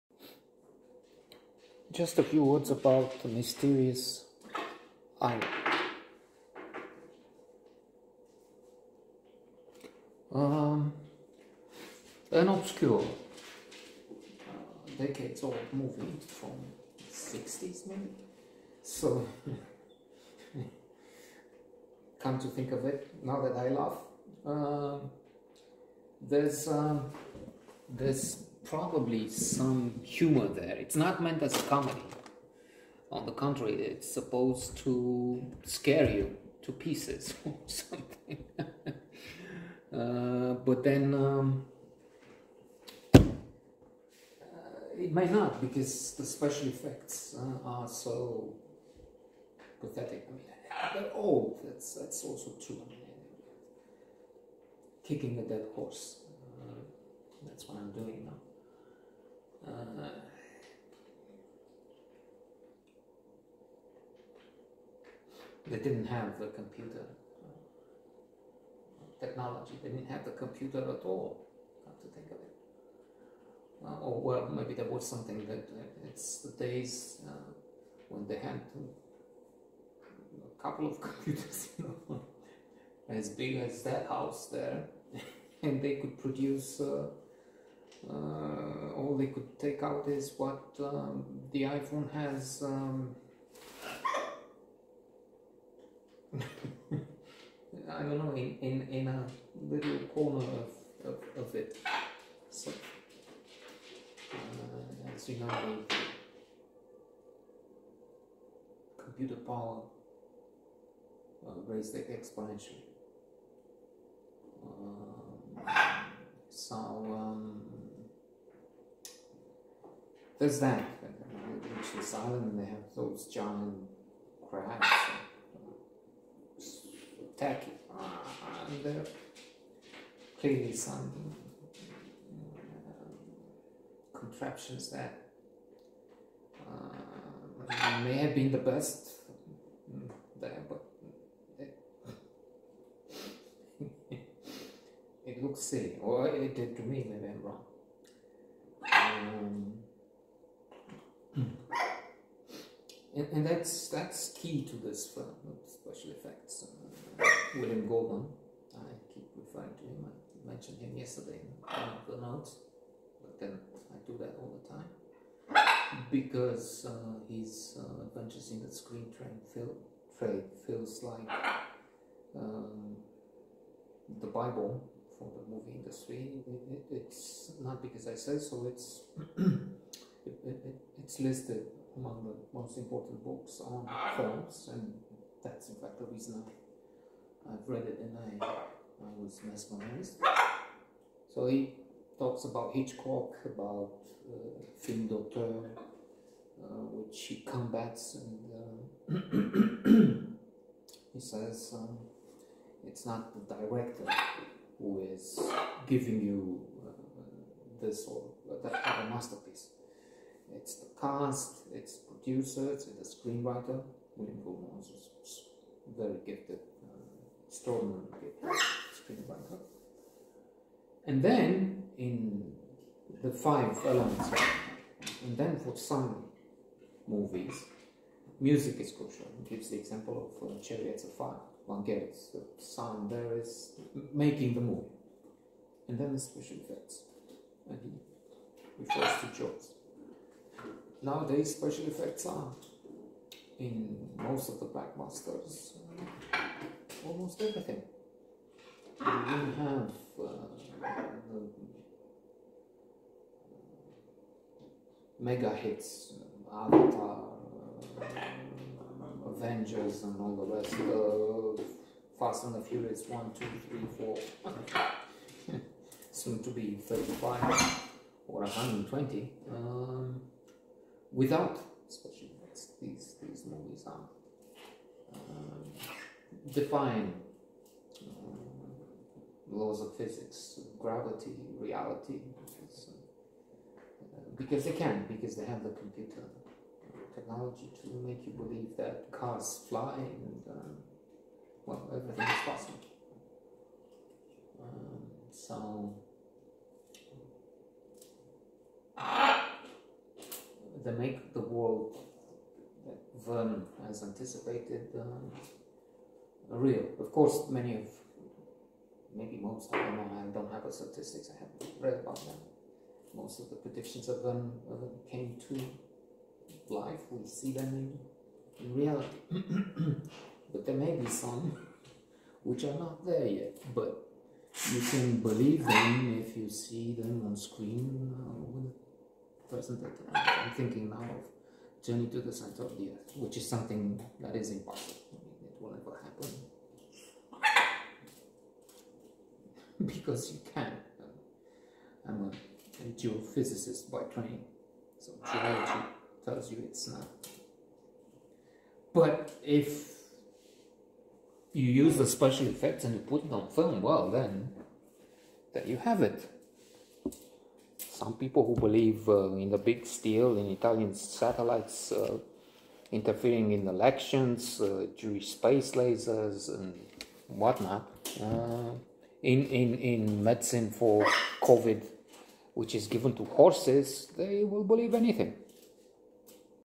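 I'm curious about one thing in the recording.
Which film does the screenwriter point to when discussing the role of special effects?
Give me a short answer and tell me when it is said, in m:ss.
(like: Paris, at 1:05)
Jaws, at 3:59.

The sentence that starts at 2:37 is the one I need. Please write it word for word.
Uh, William Goldman, I keep referring to him.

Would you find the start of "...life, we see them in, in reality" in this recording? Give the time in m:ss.
5:16.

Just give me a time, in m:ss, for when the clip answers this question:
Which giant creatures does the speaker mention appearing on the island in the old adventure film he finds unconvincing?
2:03.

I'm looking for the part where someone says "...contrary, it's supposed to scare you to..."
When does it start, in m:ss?
0:33.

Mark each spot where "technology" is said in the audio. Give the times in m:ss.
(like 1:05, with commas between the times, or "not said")
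1:09, 4:47.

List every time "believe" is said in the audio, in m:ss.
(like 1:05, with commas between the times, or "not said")
4:48, 5:25, 5:58, 6:14.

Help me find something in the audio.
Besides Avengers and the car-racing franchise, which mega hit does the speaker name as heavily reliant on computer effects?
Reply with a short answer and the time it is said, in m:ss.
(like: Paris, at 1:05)
Avatar, at 4:16.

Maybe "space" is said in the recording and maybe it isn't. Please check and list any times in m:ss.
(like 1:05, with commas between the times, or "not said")
6:05.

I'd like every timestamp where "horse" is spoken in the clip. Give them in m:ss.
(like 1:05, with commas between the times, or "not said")
0:55, 6:13.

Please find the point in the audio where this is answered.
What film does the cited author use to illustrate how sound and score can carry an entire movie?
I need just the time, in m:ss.
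3:50.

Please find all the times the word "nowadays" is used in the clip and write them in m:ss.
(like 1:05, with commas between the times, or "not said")
4:01.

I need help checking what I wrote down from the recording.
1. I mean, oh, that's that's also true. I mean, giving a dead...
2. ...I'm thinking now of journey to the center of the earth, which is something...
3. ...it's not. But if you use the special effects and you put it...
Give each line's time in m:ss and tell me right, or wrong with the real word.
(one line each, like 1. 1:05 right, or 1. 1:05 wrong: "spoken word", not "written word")
1. 0:50 wrong: "kicking", not "giving"
2. 5:29 right
3. 5:46 right.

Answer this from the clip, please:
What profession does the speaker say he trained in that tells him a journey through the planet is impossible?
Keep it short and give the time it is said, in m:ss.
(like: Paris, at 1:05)
Geophysicist, at 5:42.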